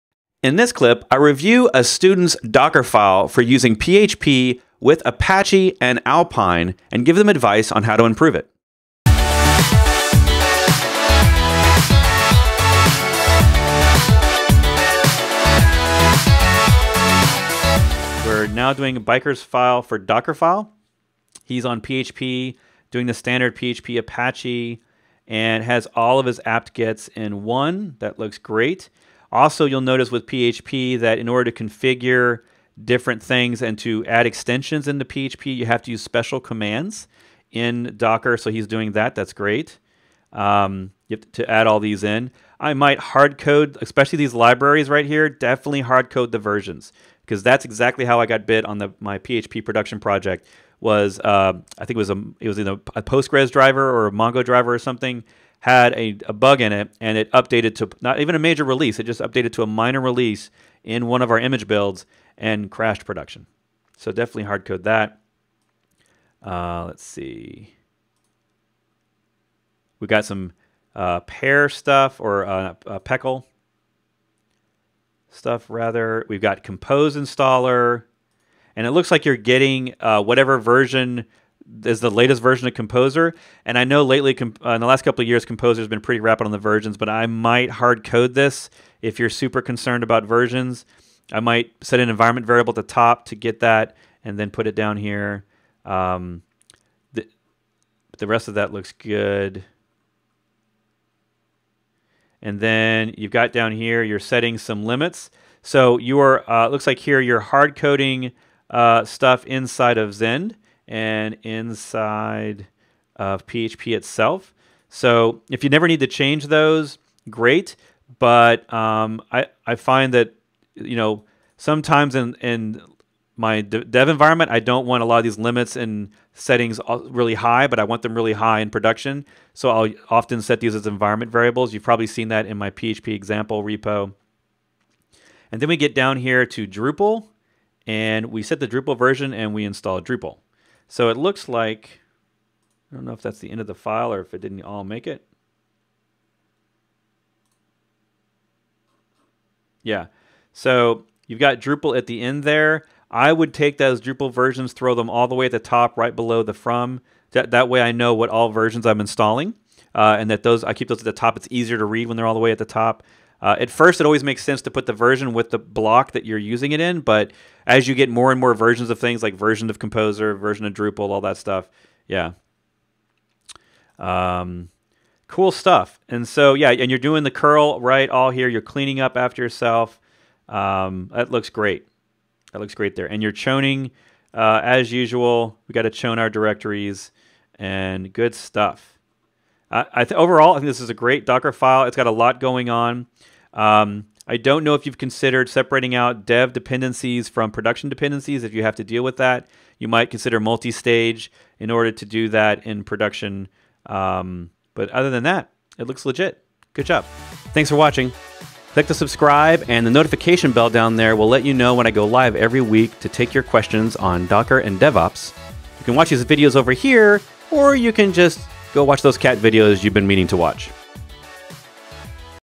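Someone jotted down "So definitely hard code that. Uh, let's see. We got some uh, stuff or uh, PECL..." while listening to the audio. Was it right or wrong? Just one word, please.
right.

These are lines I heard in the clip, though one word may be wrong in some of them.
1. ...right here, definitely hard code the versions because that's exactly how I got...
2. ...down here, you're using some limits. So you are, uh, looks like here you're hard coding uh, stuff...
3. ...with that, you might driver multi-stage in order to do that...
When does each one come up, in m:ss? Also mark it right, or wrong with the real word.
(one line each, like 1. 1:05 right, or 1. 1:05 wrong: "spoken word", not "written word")
1. 0:44 right
2. 1:43 wrong: "setting", not "using"
3. 3:19 wrong: "consider", not "driver".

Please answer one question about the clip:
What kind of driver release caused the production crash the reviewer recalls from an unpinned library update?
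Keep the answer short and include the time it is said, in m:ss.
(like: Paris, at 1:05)
minor release, at 0:59.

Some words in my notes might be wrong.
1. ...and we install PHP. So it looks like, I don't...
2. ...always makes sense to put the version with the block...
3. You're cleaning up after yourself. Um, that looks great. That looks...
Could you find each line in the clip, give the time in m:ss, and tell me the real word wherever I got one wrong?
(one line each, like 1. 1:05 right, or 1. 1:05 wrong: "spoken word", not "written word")
1. 2:19 wrong: "Drupal", not "PHP"
2. 2:44 right
3. 2:58 right.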